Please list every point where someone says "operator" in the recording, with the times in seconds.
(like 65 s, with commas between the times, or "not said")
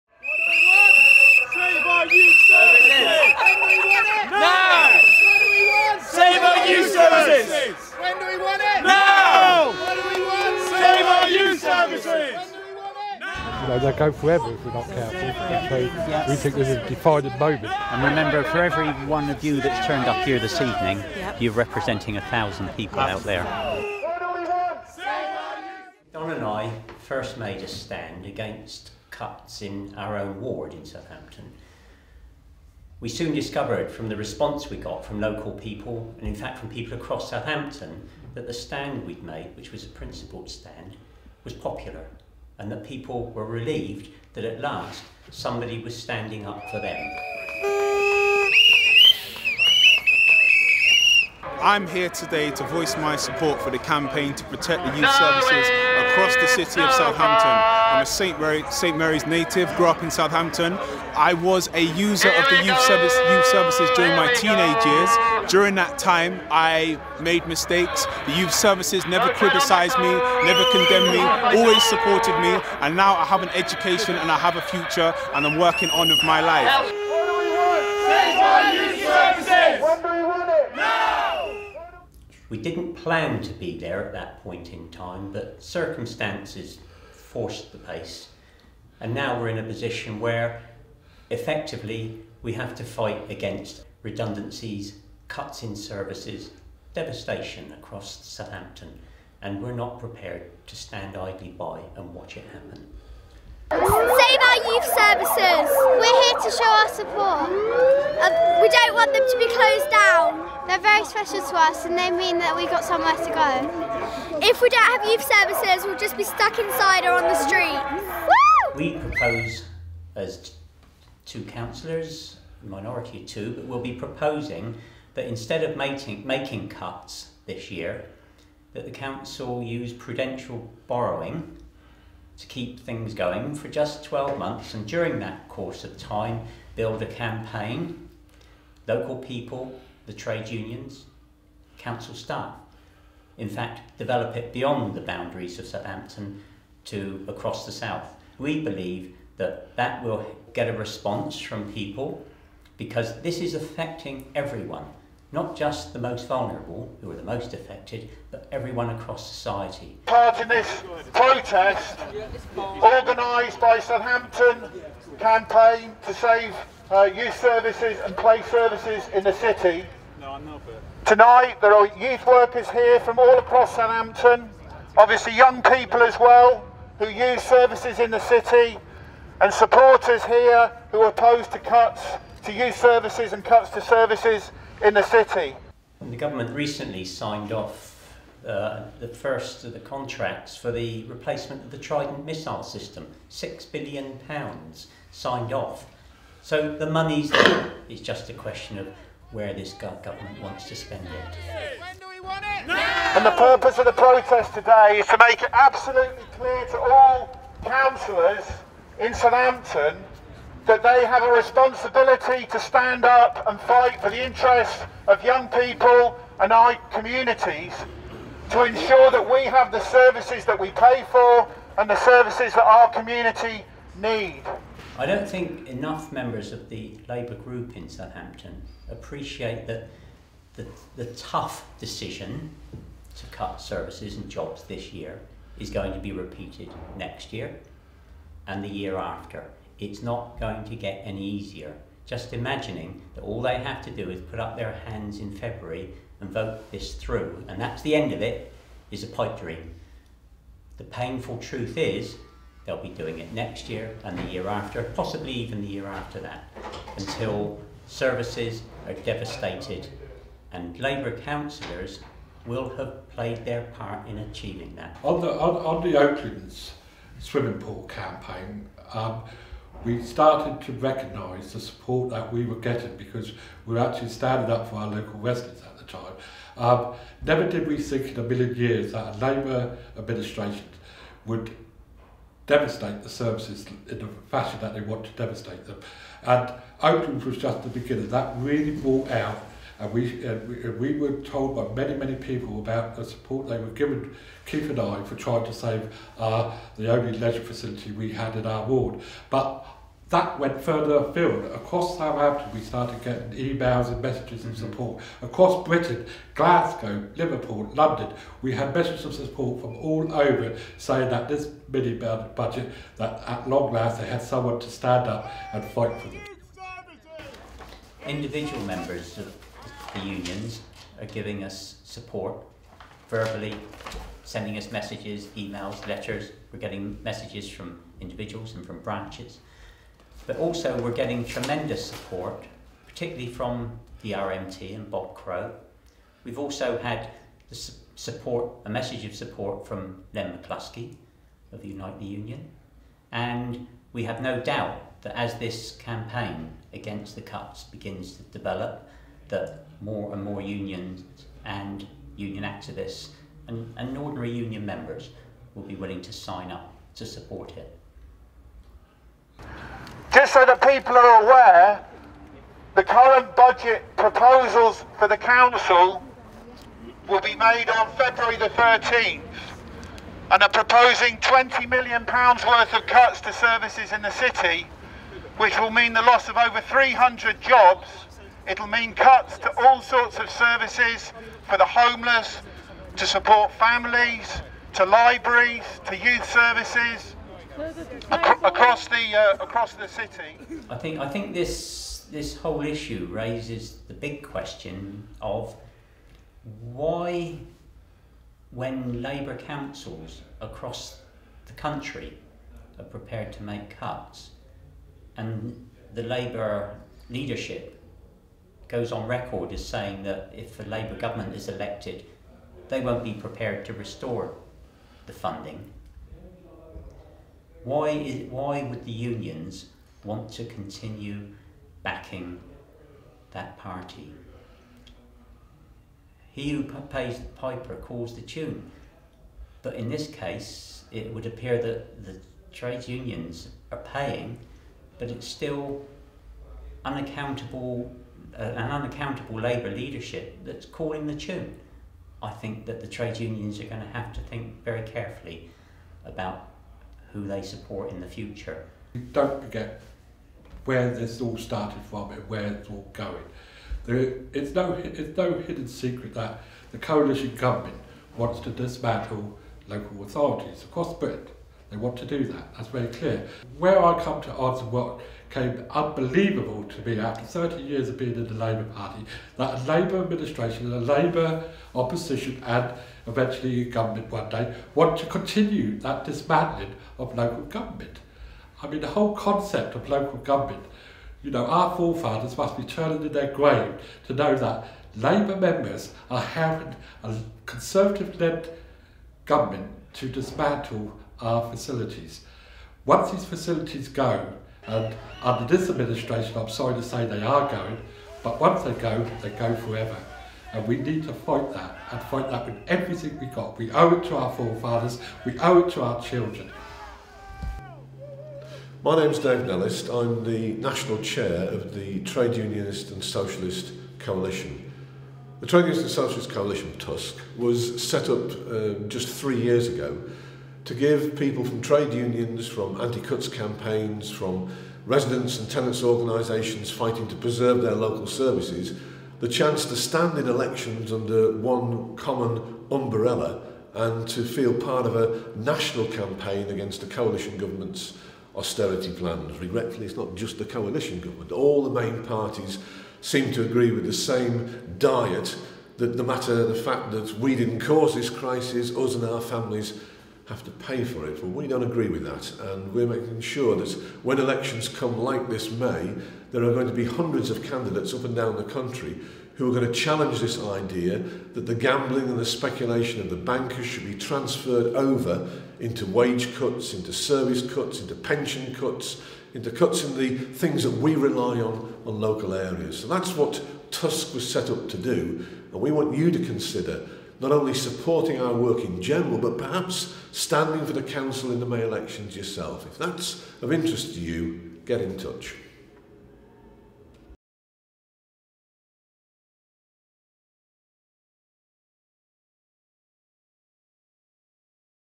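not said.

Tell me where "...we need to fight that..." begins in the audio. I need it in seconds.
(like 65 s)
500 s.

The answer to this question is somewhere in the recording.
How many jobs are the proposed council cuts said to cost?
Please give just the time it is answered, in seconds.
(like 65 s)
376 s.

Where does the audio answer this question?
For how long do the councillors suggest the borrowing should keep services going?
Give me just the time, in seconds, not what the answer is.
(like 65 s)
134 s.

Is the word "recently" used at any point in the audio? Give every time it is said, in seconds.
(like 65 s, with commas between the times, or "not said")
186 s.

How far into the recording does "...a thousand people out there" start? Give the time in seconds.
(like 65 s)
22 s.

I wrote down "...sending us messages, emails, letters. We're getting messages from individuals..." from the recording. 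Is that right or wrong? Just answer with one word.
right.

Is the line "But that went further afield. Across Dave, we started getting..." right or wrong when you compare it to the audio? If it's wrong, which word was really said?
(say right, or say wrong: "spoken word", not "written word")
wrong: "Southampton", not "Dave".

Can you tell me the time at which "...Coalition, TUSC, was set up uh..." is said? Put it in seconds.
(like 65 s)
516 s.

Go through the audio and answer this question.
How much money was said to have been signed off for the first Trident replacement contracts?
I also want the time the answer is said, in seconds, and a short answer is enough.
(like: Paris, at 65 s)
six billion pounds, at 193 s.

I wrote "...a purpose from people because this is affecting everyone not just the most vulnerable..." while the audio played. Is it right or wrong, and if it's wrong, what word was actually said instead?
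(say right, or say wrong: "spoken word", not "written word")
wrong: "response", not "purpose".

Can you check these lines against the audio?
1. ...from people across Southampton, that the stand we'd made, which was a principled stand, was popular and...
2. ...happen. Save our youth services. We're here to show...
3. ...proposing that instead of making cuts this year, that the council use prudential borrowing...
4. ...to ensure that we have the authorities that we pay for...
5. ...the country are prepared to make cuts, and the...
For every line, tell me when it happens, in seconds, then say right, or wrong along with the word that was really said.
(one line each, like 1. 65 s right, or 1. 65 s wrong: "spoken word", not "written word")
1. 36 s right
2. 102 s right
3. 123 s right
4. 218 s wrong: "services", not "authorities"
5. 401 s right.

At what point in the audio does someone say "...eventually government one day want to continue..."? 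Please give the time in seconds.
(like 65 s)
473 s.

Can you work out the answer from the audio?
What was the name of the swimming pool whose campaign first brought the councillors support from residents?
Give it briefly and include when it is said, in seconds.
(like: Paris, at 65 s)
Oaklands, at 265 s.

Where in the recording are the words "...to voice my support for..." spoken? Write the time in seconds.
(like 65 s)
52 s.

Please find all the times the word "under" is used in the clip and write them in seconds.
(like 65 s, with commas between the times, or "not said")
495 s, 530 s.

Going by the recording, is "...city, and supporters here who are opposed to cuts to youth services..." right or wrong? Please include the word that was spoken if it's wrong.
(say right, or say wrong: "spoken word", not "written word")
right.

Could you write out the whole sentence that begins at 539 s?
Regretfully, it's not just the coalition government.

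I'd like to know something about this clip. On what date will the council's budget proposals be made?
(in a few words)
February 13th.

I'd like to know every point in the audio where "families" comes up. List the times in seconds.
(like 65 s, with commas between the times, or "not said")
383 s, 549 s.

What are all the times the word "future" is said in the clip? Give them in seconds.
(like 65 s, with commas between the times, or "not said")
74 s, 448 s.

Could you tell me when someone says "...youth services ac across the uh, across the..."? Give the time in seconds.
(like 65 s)
385 s.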